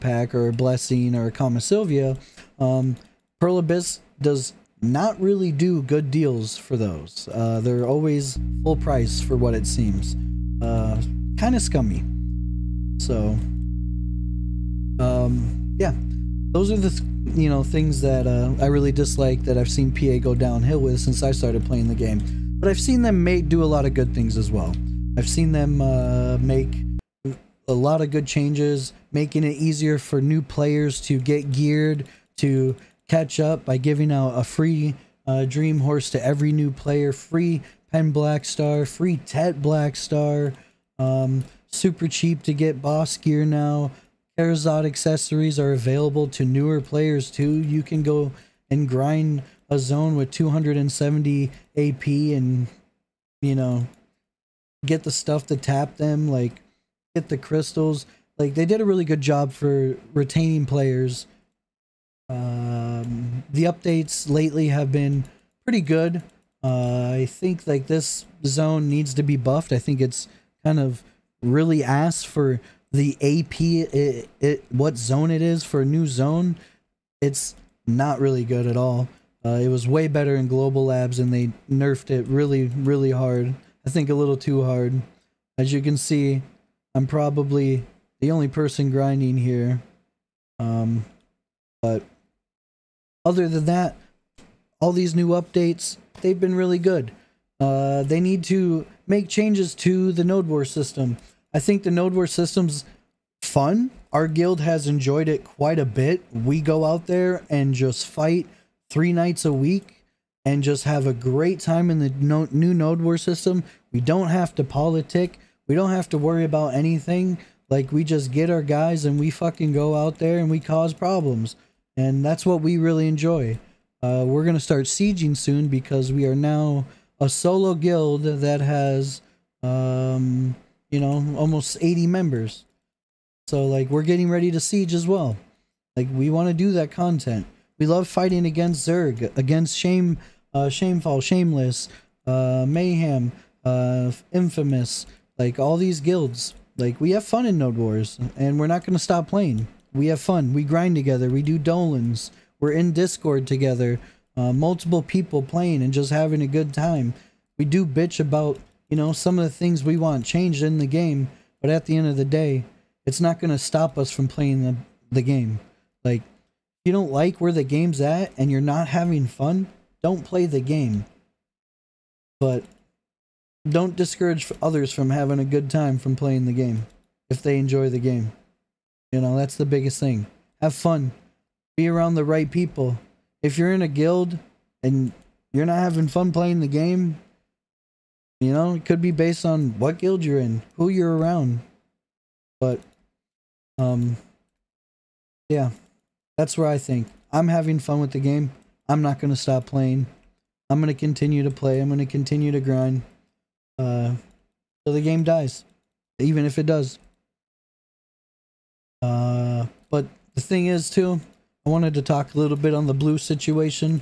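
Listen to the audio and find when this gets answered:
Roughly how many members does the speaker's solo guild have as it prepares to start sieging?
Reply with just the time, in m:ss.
2:11.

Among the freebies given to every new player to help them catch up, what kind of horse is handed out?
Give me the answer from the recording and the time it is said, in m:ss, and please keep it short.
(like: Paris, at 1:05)
Dream horse, at 0:35.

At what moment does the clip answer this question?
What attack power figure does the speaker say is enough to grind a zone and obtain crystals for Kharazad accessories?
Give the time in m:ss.
0:50.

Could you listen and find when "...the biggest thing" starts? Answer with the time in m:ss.
2:59.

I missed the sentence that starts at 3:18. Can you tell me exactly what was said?
I'm not going to stop playing.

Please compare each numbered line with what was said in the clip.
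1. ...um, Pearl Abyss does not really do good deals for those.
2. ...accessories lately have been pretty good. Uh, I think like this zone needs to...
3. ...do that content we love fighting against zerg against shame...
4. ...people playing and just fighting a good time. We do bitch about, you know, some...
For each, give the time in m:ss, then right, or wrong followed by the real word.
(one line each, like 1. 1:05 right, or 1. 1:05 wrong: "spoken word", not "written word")
1. 0:02 right
2. 1:03 wrong: "updates", not "accessories"
3. 2:16 right
4. 2:35 wrong: "having", not "fighting".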